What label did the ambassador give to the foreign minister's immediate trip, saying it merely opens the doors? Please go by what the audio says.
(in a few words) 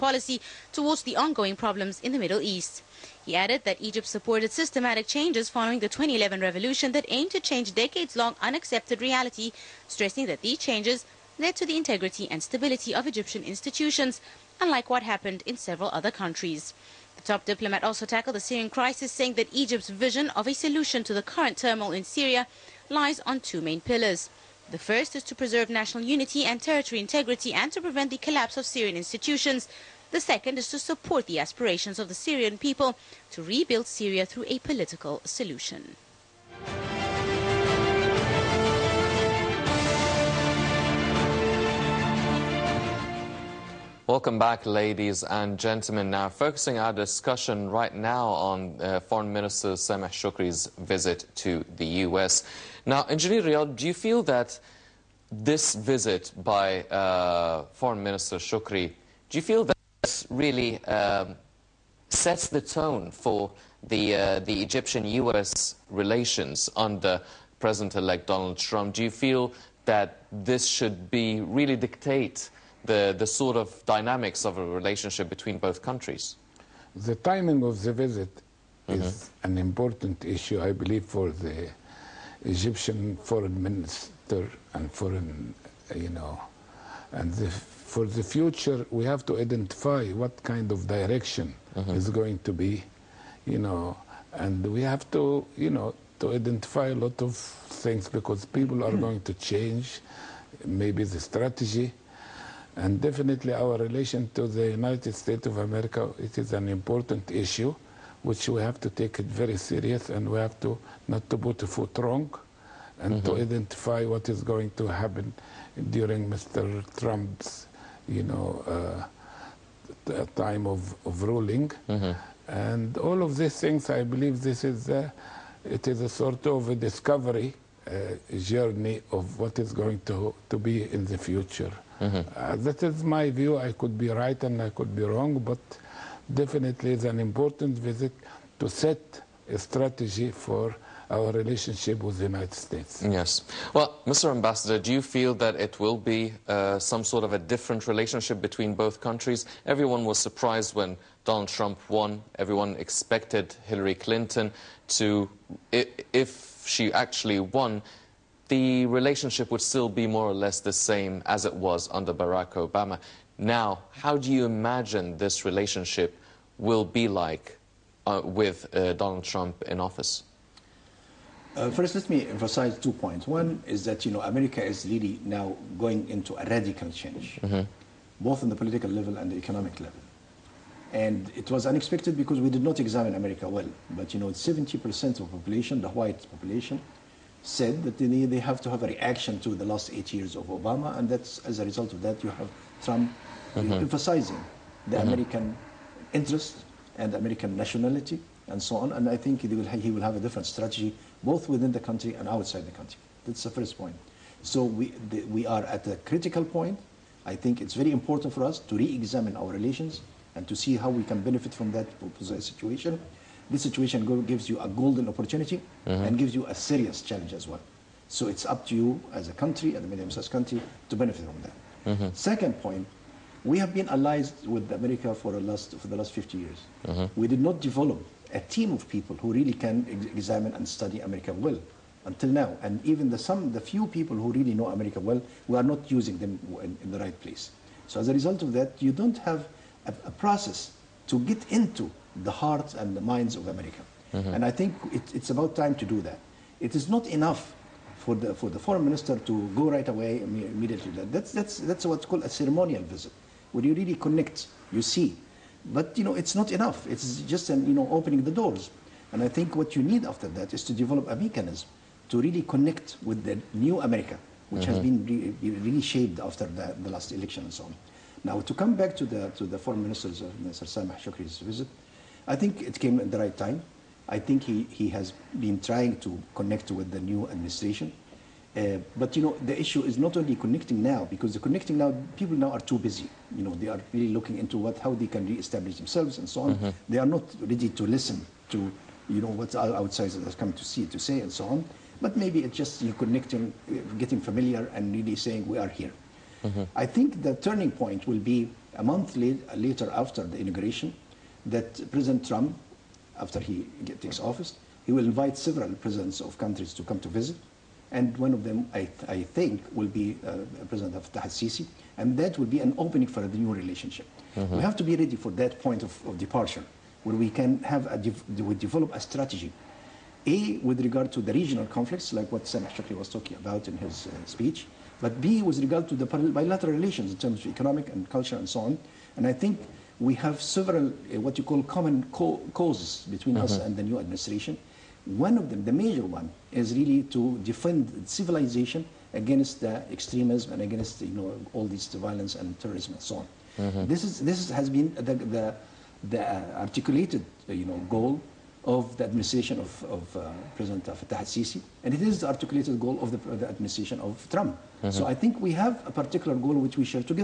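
ceremonial visit.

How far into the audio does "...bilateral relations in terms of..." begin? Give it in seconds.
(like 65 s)
326 s.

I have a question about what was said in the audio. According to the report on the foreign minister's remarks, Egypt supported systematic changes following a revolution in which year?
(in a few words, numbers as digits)
2011.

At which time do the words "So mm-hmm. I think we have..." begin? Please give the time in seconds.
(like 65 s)
354 s.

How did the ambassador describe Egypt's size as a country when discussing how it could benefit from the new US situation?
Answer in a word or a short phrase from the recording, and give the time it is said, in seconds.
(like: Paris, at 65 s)
medium-sized, at 219 s.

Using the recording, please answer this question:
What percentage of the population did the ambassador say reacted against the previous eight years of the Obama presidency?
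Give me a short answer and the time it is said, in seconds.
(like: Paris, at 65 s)
70%, at 184 s.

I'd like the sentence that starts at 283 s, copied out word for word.
You know, they are really looking into what, how they can re-establish themselves and so on.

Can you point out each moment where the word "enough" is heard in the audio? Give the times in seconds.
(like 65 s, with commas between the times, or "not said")
247 s, 256 s.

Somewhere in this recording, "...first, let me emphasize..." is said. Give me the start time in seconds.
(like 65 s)
171 s.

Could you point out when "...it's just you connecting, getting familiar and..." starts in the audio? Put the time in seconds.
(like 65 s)
292 s.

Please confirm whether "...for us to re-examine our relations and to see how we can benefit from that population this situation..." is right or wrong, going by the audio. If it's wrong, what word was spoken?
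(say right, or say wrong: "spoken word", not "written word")
wrong: "situation", not "population".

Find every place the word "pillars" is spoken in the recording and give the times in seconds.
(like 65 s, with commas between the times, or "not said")
23 s.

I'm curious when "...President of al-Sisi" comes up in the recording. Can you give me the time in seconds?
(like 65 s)
310 s.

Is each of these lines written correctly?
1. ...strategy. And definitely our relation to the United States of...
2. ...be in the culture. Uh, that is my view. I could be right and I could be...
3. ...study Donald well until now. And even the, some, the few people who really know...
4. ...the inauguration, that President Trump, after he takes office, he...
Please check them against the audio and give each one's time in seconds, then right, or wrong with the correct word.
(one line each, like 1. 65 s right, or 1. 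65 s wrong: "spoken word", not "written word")
1. 101 s right
2. 130 s wrong: "future", not "culture"
3. 230 s wrong: "America", not "Donald"
4. 300 s right.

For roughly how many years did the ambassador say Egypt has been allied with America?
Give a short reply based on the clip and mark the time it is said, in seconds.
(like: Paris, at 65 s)
50 years, at 226 s.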